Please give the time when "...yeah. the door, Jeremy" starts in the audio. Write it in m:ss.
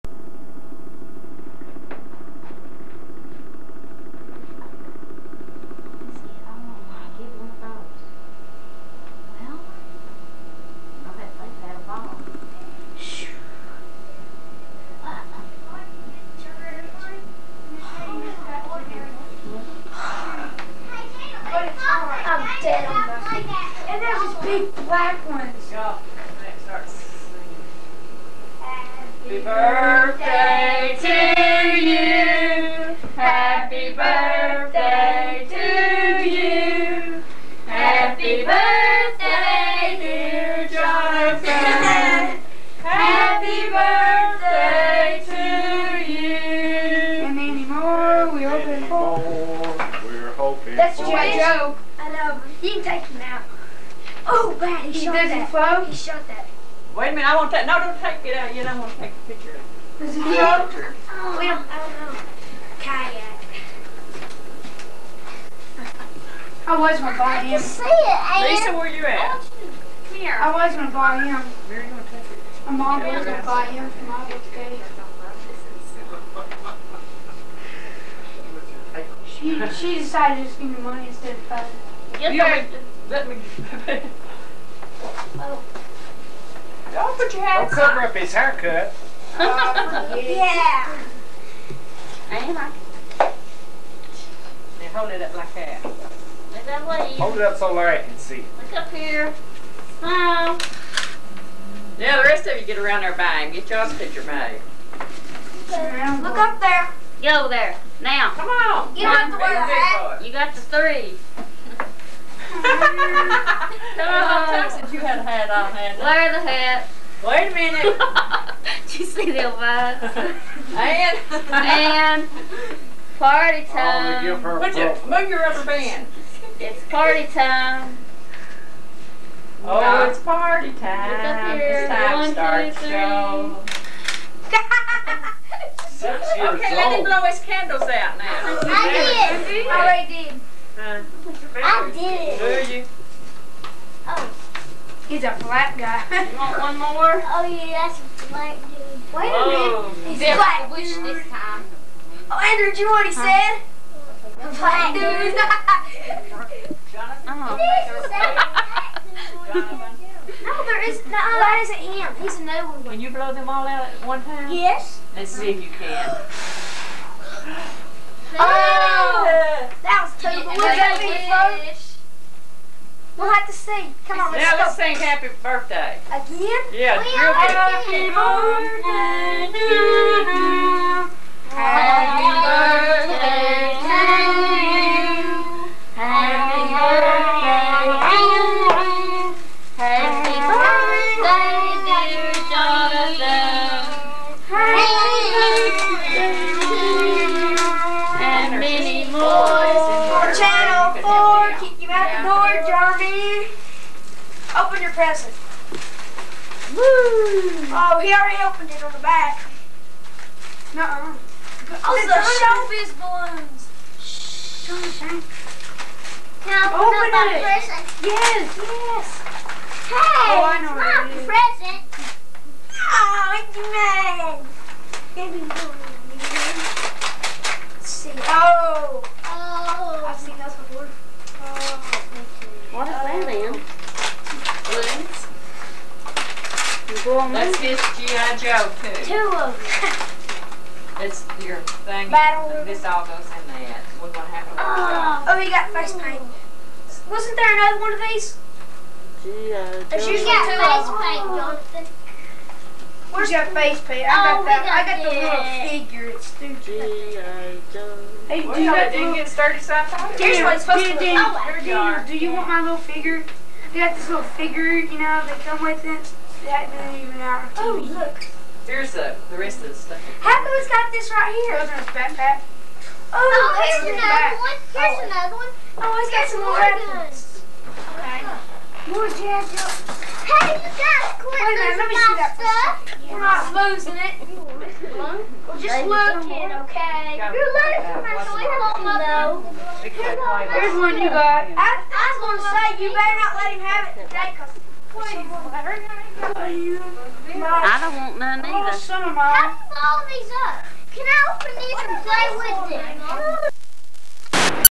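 3:22.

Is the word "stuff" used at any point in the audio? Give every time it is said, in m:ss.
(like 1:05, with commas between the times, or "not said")
4:29, 4:42.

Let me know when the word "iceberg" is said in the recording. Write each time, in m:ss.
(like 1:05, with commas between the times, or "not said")
not said.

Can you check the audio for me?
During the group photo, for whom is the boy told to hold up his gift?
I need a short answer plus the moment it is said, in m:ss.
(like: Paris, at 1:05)
Larry, at 1:37.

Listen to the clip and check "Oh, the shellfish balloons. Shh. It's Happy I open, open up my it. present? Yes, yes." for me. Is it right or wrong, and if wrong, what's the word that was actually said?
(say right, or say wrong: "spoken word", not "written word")
wrong: "Can", not "Happy".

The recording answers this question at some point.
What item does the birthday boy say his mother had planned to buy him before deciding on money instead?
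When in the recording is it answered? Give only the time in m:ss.
1:02.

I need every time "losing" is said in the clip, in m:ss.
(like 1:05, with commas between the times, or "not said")
4:43, 4:47.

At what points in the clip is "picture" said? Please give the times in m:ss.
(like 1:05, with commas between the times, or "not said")
0:59, 1:43.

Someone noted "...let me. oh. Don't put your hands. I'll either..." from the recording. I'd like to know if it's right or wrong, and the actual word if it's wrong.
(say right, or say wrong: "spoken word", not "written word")
wrong: "cover", not "either".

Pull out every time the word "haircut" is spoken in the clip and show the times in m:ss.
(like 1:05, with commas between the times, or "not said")
1:28.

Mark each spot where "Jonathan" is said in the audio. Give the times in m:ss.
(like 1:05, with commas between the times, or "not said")
0:40, 2:36, 4:11.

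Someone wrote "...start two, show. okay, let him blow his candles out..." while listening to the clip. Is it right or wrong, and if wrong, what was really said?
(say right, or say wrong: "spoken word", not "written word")
right.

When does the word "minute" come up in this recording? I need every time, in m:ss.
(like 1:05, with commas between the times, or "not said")
0:57, 1:57, 2:30, 4:41.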